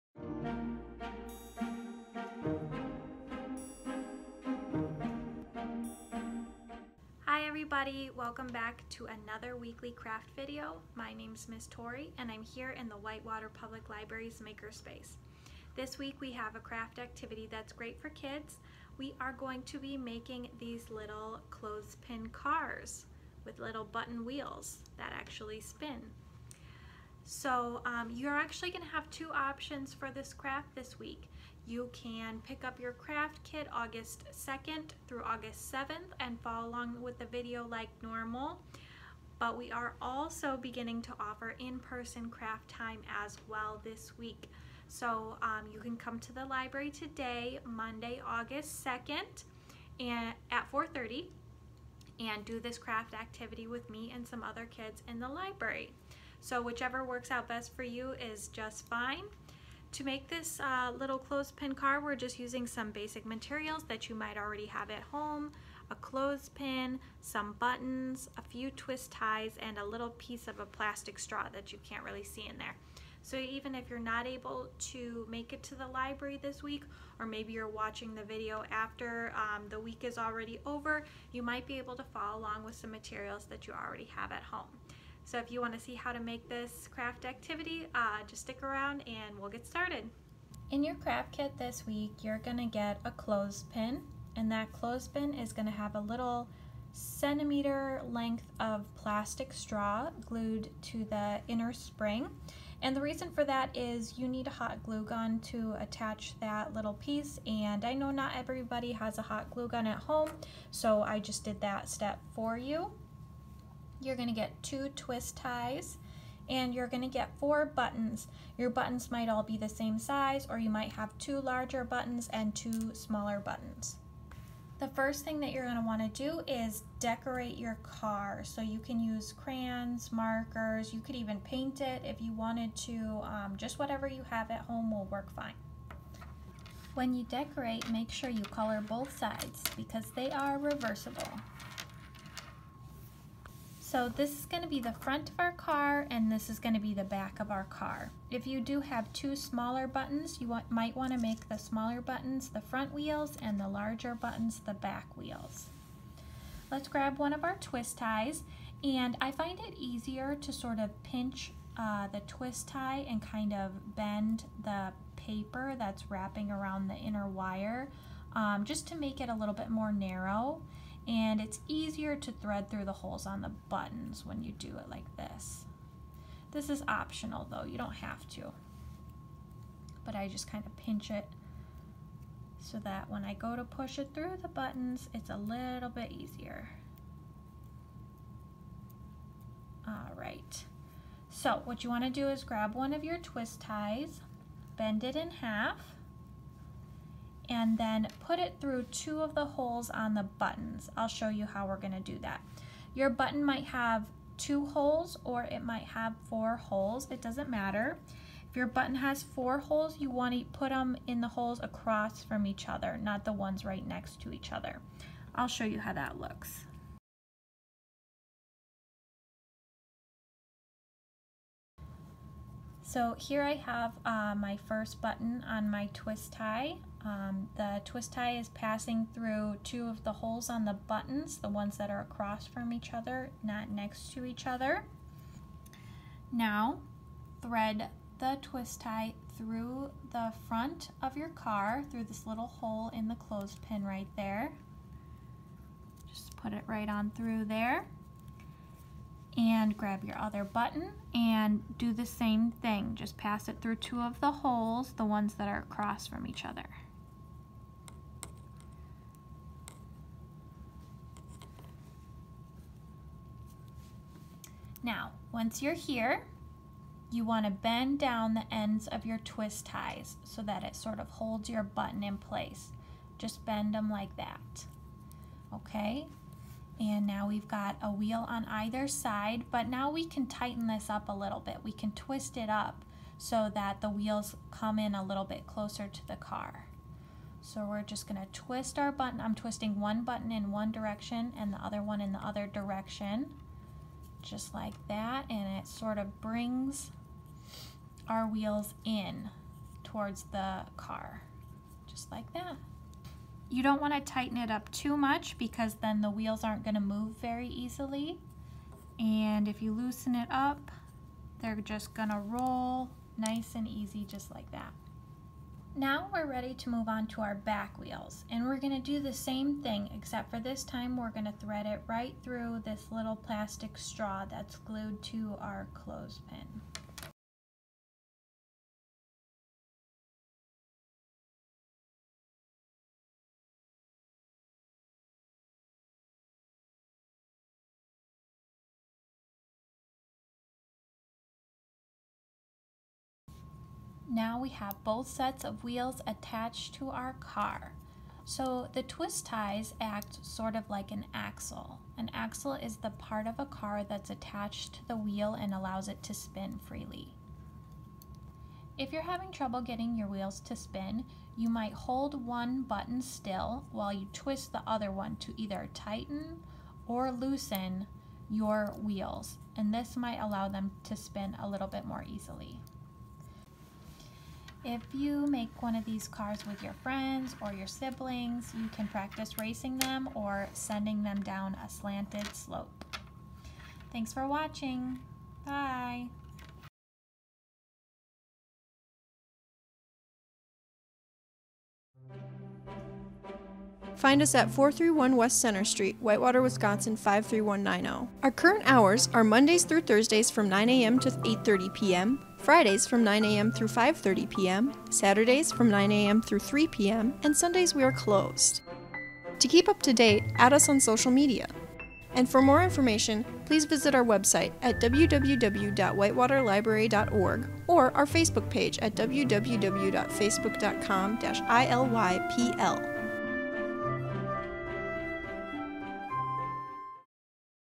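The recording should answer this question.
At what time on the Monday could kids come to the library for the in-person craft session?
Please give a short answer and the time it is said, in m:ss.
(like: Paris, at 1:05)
4:30, at 0:50.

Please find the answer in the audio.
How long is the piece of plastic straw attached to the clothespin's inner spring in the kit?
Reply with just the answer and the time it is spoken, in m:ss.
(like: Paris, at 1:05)
1 centimeter, at 1:36.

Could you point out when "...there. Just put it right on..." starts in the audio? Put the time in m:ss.
4:04.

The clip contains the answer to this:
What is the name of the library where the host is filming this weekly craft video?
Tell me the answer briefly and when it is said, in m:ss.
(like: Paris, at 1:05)
Whitewater Public Library, at 0:12.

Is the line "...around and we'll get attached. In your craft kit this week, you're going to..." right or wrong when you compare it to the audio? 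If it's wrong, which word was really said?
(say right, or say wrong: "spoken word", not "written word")
wrong: "started", not "attached".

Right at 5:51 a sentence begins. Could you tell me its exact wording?
An axle is the part of a car that's attached to the wheel and allows it to spin freely.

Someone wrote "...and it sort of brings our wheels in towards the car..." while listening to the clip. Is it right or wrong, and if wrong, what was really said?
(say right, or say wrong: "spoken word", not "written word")
right.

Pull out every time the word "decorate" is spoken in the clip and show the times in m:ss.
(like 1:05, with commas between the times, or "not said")
2:06, 2:17.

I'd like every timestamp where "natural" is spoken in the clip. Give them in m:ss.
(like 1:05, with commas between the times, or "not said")
not said.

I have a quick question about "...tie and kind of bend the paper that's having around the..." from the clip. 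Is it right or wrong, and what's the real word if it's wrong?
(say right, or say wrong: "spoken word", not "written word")
wrong: "wrapping", not "having".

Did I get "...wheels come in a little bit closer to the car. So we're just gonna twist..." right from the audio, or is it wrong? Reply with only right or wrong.
right.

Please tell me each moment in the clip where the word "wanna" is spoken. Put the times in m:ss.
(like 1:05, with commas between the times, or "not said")
3:11, 3:30.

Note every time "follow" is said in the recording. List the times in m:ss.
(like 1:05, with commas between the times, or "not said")
0:36, 1:22.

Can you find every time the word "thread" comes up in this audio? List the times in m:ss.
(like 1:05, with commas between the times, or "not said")
2:52, 3:57, 5:21.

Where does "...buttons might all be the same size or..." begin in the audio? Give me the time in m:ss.
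1:58.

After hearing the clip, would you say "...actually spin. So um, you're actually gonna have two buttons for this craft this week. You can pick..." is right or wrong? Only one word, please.
wrong.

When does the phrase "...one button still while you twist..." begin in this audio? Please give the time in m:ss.
6:02.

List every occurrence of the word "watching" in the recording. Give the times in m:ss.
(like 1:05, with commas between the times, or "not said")
1:17, 6:24.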